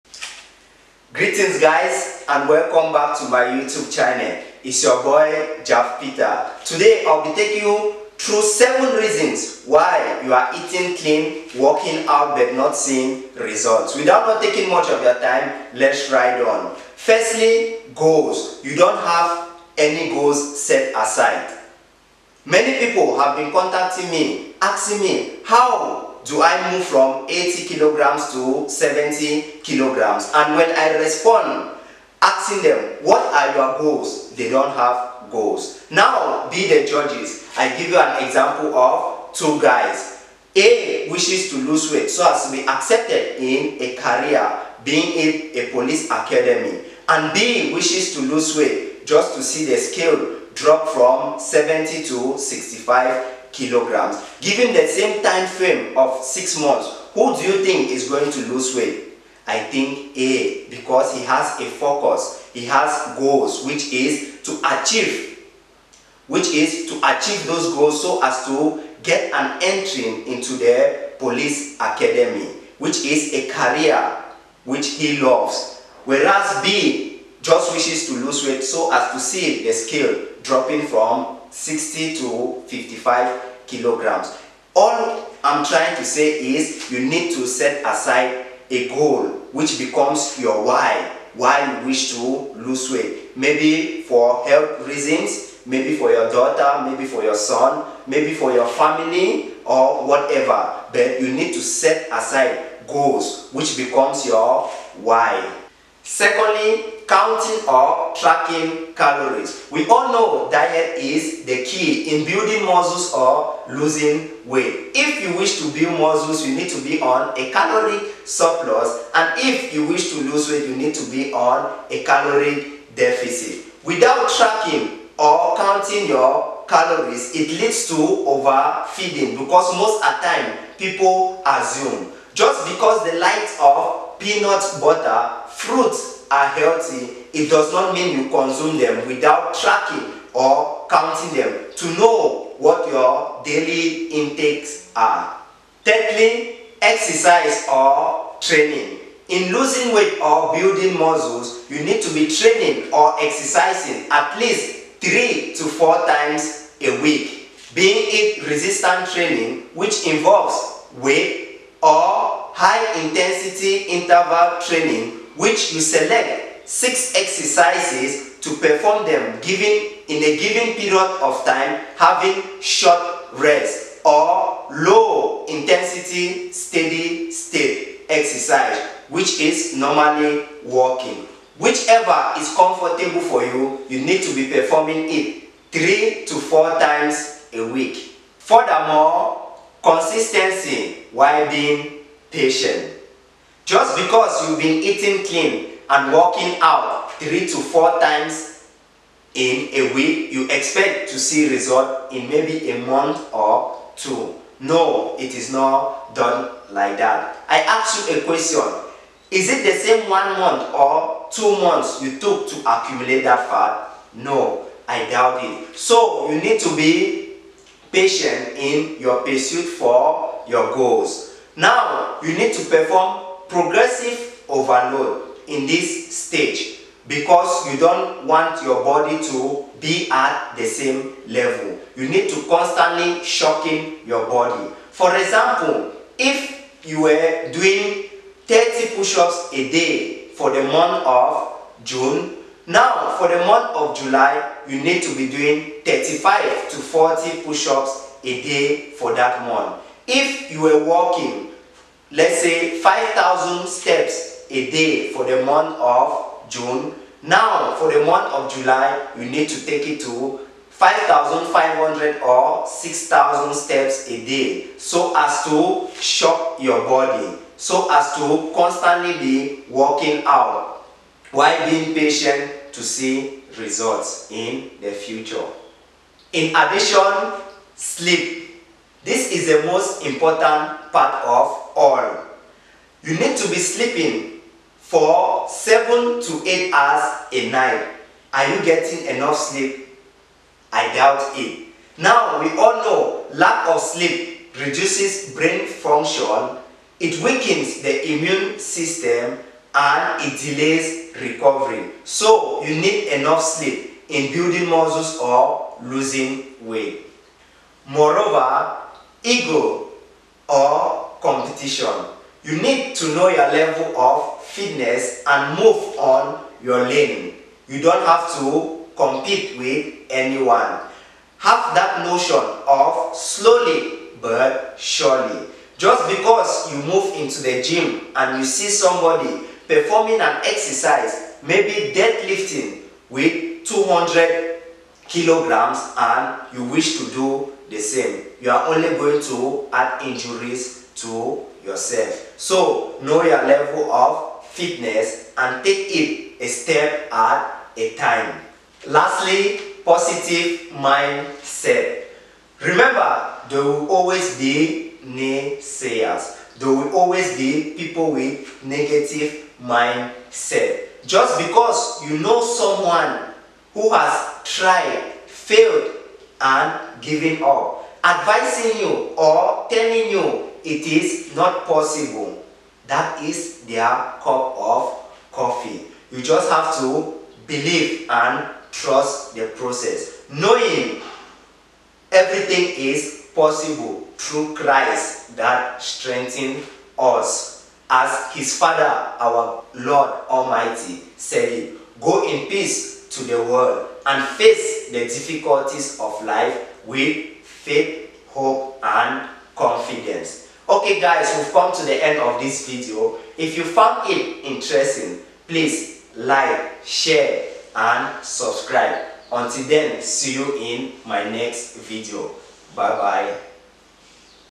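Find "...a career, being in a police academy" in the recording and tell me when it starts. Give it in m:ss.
0:43.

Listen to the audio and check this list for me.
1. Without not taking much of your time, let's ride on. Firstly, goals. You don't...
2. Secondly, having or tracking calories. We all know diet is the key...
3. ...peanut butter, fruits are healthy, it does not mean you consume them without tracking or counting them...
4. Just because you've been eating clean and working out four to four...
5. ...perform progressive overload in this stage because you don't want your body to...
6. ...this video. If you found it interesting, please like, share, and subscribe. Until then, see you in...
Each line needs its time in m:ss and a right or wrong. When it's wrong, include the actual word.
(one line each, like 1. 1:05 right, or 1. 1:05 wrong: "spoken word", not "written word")
1. 0:13 right
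2. 1:46 wrong: "counting", not "having"
3. 2:14 right
4. 3:13 wrong: "three", not "four"
5. 3:42 right
6. 6:42 right.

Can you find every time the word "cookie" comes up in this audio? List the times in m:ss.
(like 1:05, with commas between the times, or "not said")
not said.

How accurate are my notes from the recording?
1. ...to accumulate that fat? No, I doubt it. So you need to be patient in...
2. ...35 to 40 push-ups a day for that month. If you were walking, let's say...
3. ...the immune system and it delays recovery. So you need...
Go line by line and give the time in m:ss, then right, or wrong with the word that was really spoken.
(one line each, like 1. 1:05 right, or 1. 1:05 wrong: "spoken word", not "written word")
1. 3:32 right
2. 4:05 right
3. 4:57 right.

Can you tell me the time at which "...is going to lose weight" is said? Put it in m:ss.
0:57.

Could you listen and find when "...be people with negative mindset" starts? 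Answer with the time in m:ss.
5:57.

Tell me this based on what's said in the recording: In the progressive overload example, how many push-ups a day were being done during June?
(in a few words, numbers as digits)
30.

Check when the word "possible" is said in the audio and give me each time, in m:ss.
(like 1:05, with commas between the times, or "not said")
6:11, 6:23.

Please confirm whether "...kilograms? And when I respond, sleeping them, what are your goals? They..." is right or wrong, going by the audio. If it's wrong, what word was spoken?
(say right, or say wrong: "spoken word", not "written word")
wrong: "asking", not "sleeping".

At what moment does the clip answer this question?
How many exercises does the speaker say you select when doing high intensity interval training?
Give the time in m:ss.
2:46.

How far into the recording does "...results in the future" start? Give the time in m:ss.
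4:33.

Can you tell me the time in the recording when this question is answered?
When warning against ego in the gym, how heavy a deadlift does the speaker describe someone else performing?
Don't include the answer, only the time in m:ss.
5:33.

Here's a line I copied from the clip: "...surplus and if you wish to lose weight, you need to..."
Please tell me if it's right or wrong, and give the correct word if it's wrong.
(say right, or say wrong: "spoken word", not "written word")
right.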